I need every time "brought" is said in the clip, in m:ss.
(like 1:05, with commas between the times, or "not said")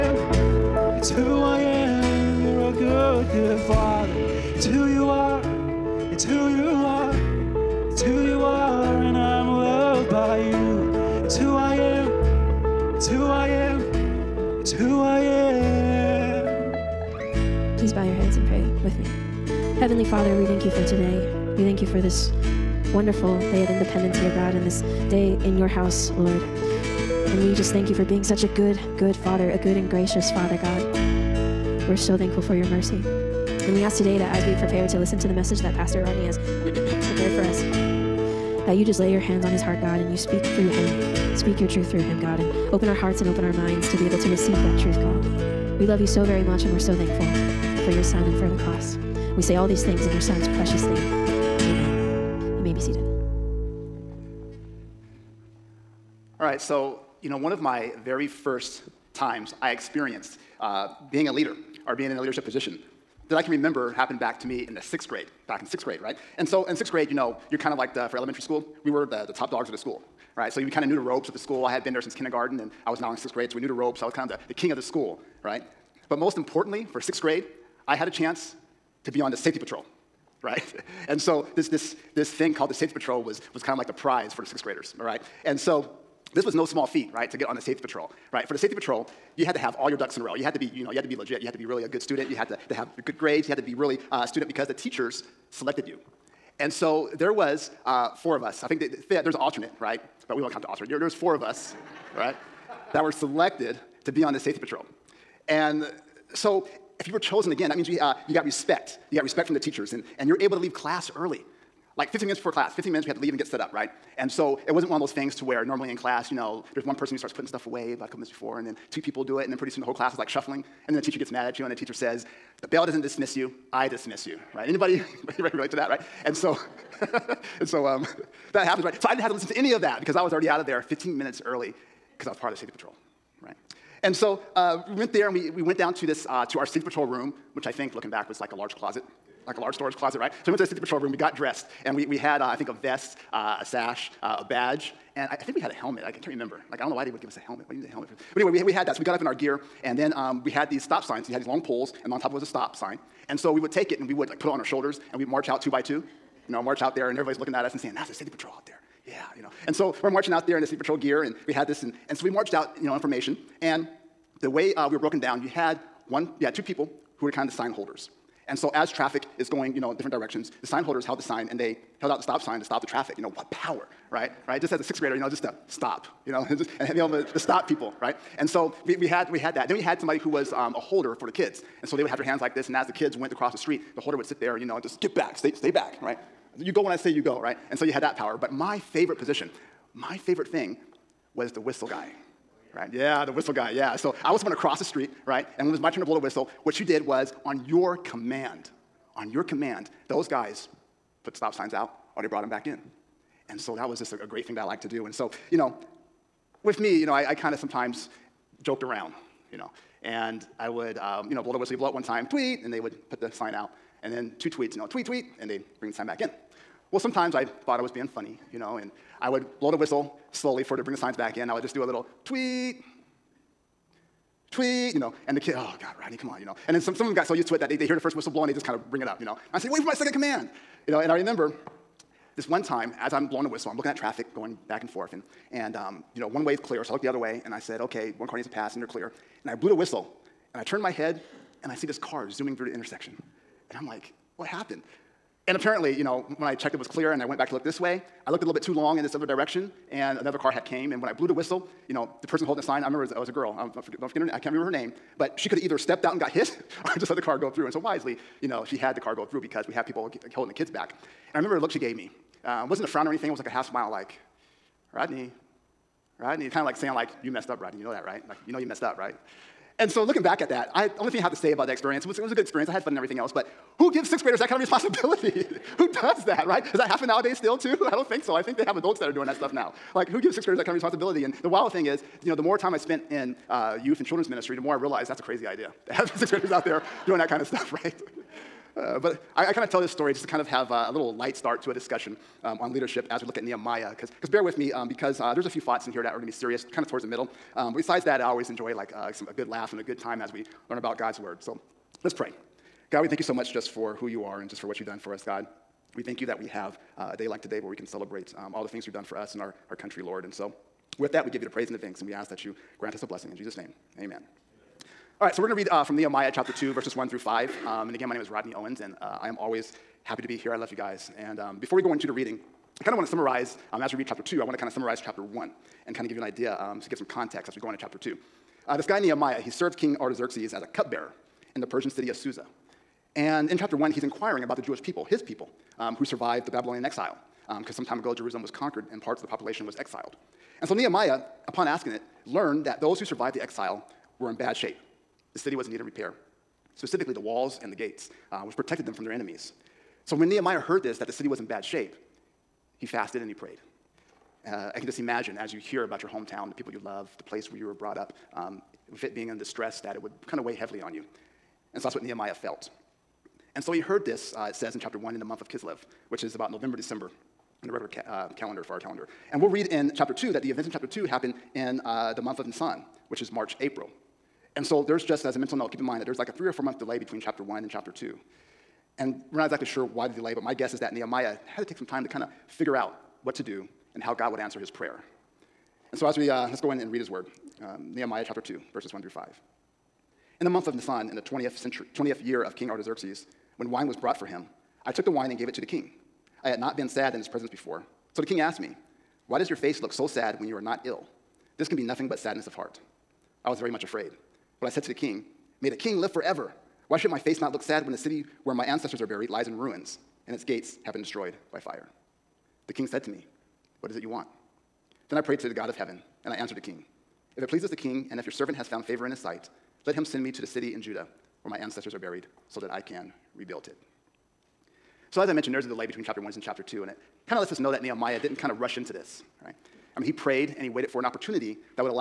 3:22, 5:57, 6:33.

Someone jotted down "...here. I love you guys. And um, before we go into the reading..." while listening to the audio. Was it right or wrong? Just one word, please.
right.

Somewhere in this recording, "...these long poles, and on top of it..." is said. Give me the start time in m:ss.
2:31.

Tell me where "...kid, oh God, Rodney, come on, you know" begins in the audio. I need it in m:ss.
3:45.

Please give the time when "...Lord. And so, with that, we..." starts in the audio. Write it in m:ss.
5:10.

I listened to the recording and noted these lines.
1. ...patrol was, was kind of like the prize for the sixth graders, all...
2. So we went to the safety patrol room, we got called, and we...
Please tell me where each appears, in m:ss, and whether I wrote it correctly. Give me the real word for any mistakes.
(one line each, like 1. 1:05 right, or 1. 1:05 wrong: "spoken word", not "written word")
1. 1:22 right
2. 2:20 wrong: "dressed", not "called".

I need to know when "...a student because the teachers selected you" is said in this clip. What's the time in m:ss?
1:34.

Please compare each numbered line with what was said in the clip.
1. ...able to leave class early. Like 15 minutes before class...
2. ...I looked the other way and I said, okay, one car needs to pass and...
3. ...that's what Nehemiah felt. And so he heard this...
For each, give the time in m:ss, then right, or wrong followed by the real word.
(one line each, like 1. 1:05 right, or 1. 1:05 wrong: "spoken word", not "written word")
1. 1:50 right
2. 3:56 right
3. 6:01 right.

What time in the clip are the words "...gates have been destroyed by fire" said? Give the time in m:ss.
6:50.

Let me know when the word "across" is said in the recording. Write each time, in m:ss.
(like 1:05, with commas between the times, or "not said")
3:03, 3:14.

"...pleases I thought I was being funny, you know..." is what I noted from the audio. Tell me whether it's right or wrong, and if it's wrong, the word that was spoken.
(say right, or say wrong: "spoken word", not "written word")
wrong: "sometimes", not "pleases".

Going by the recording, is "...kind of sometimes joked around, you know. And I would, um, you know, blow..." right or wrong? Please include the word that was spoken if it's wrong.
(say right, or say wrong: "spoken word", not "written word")
right.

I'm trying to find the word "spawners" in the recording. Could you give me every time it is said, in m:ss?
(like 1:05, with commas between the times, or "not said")
not said.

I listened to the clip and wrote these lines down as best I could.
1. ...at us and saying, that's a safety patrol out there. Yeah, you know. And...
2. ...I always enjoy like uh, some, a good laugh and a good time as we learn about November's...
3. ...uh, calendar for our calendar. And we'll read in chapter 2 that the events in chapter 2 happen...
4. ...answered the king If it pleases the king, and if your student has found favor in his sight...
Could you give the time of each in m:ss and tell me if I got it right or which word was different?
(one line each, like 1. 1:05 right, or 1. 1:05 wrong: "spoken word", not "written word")
1. 2:37 right
2. 4:58 wrong: "God", not "November"
3. 6:08 right
4. 6:56 wrong: "servant", not "student".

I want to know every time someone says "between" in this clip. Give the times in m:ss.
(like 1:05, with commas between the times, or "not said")
6:16, 7:05.